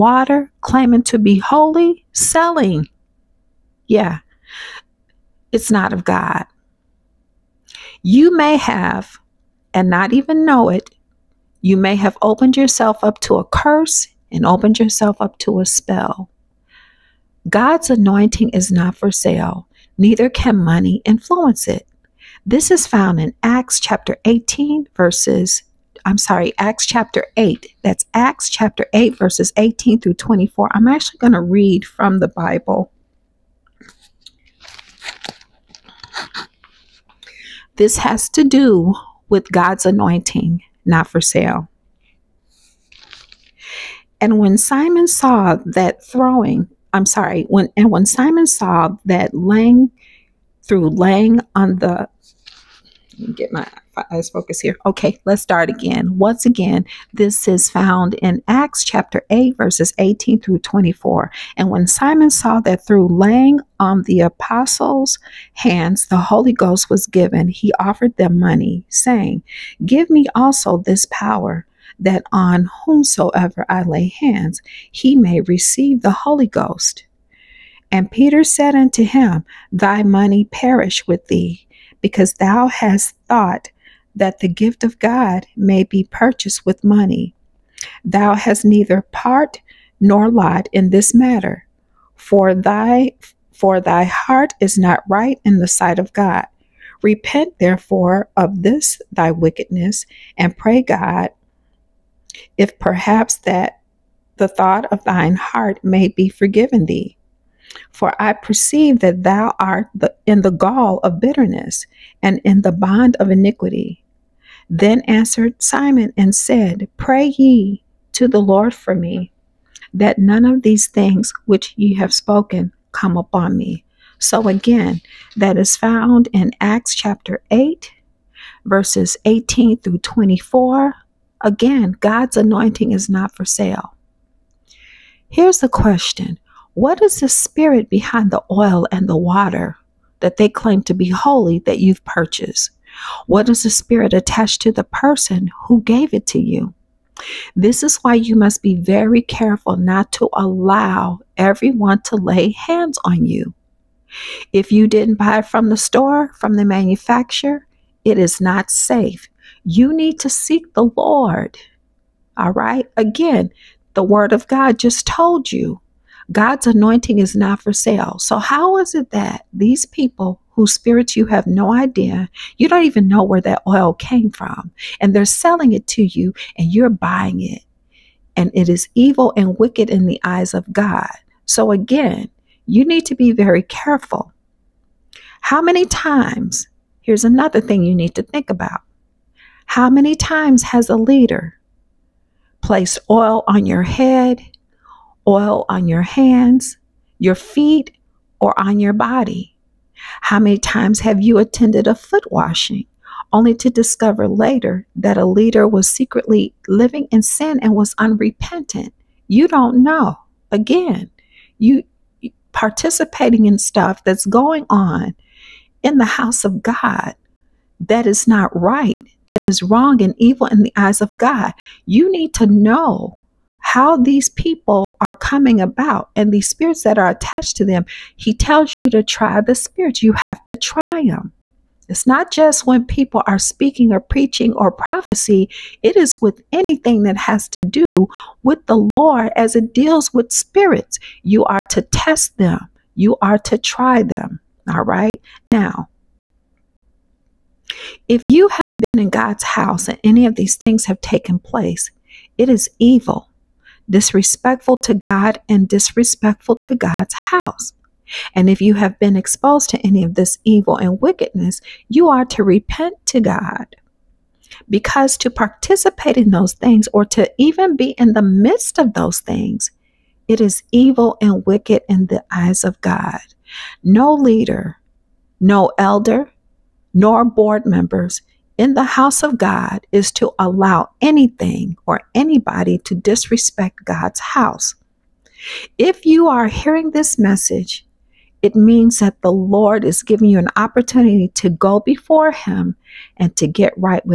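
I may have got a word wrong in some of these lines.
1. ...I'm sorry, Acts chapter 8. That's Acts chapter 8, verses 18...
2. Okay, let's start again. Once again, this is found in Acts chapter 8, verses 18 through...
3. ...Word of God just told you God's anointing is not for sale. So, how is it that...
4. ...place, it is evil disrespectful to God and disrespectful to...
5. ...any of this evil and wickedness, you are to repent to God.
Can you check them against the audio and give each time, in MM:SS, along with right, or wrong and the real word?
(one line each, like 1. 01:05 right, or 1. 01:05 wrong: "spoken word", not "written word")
1. 00:26 right
2. 00:54 right
3. 02:44 right
4. 04:11 right
5. 04:19 right.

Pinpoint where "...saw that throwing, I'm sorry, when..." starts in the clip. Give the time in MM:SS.
00:45.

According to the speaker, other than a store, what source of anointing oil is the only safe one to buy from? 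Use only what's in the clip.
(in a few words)
the manufacturer.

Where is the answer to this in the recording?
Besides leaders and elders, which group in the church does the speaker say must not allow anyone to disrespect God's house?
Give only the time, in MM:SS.
04:37.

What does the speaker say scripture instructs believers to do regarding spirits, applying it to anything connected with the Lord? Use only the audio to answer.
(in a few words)
try the spirits.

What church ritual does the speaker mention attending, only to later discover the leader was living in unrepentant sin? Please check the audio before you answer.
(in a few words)
foot washing.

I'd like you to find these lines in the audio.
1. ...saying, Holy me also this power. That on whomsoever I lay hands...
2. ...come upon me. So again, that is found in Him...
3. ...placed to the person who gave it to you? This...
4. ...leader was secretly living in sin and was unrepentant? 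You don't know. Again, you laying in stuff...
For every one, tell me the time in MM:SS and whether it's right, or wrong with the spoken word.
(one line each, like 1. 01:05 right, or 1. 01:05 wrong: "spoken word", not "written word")
1. 01:08 wrong: "Give", not "Holy"
2. 02:02 wrong: "Acts", not "Him"
3. 02:24 wrong: "attached", not "placed"
4. 03:25 wrong: "participating", not "laying".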